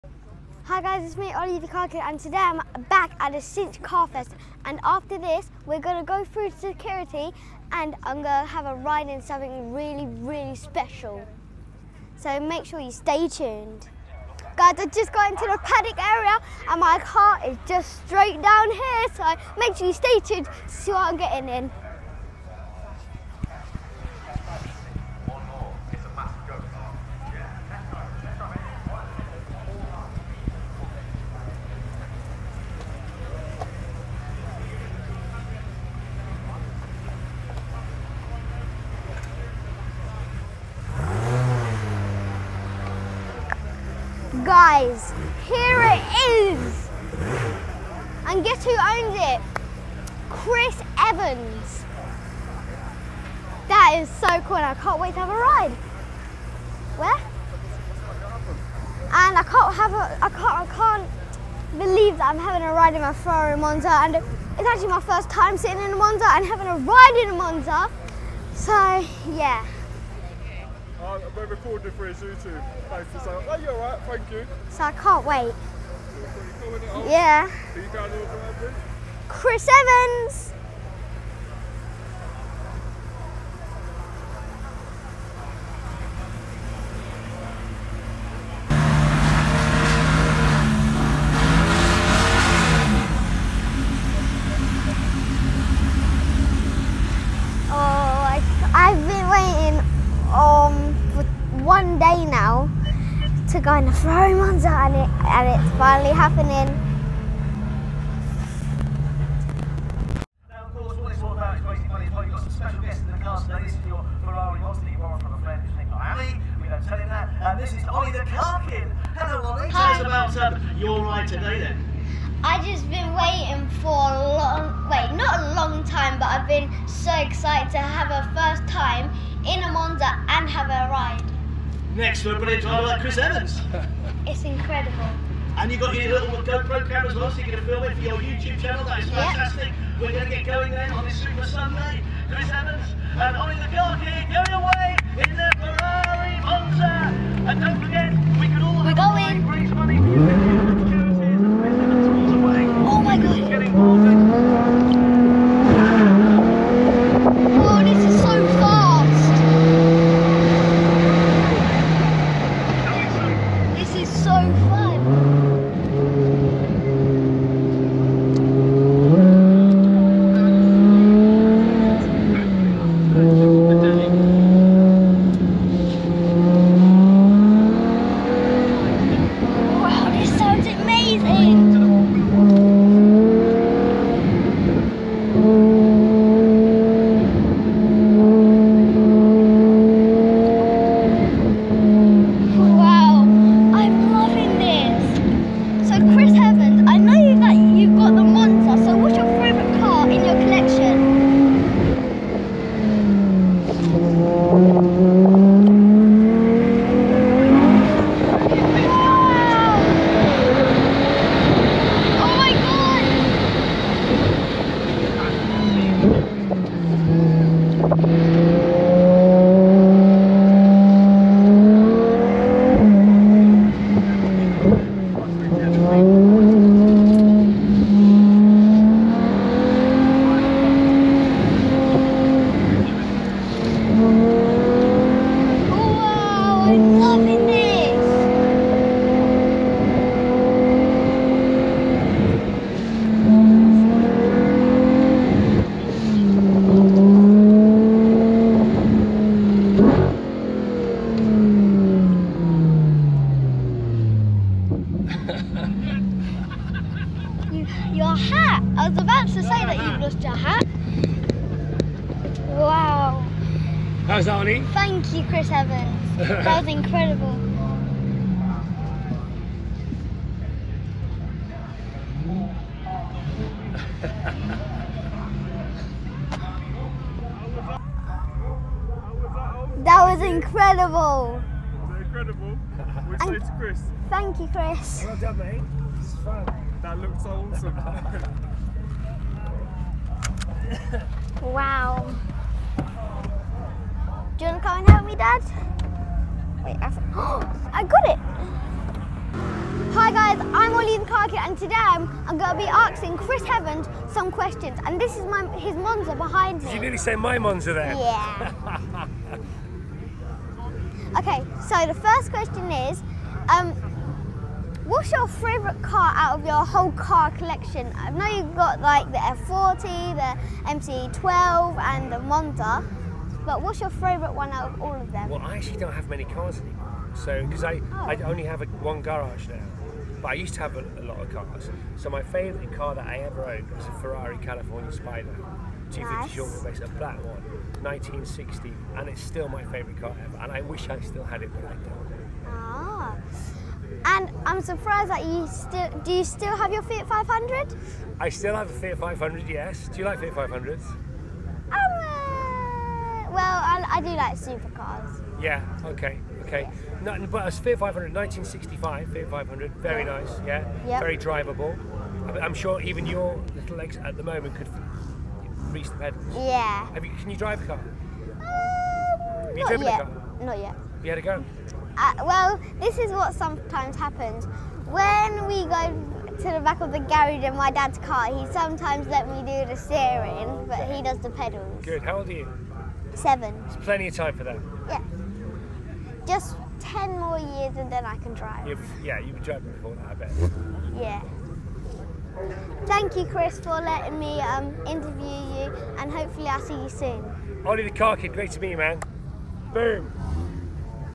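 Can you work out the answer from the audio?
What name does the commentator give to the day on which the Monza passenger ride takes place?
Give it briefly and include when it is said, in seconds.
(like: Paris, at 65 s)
Super Sunday, at 141 s.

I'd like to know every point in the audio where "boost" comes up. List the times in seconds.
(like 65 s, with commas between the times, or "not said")
not said.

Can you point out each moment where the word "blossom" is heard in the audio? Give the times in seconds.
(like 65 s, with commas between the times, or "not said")
not said.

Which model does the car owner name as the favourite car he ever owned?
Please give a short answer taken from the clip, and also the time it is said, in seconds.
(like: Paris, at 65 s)
Ferrari California Spider, at 333 s.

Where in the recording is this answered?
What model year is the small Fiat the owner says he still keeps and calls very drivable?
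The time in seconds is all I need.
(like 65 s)
358 s.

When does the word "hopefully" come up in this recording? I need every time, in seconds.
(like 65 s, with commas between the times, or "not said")
396 s.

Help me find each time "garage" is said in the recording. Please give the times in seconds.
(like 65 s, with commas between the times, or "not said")
329 s, 376 s.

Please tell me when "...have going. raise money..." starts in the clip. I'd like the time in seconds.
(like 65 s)
148 s.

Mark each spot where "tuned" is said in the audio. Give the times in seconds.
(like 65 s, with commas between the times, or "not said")
13 s, 20 s.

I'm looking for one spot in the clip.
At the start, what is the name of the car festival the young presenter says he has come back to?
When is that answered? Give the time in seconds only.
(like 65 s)
3 s.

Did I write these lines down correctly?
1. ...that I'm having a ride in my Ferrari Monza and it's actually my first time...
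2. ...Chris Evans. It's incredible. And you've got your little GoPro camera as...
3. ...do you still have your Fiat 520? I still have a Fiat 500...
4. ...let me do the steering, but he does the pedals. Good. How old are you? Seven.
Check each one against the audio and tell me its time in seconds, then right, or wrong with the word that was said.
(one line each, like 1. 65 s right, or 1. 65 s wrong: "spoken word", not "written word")
1. 62 s right
2. 133 s right
3. 346 s wrong: "500", not "520"
4. 379 s right.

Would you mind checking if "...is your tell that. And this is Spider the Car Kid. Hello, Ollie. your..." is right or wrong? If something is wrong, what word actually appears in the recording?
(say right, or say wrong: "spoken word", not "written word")
wrong: "Ollie", not "Spider".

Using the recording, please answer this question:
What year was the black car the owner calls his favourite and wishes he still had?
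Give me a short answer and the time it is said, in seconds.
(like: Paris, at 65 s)
1960, at 337 s.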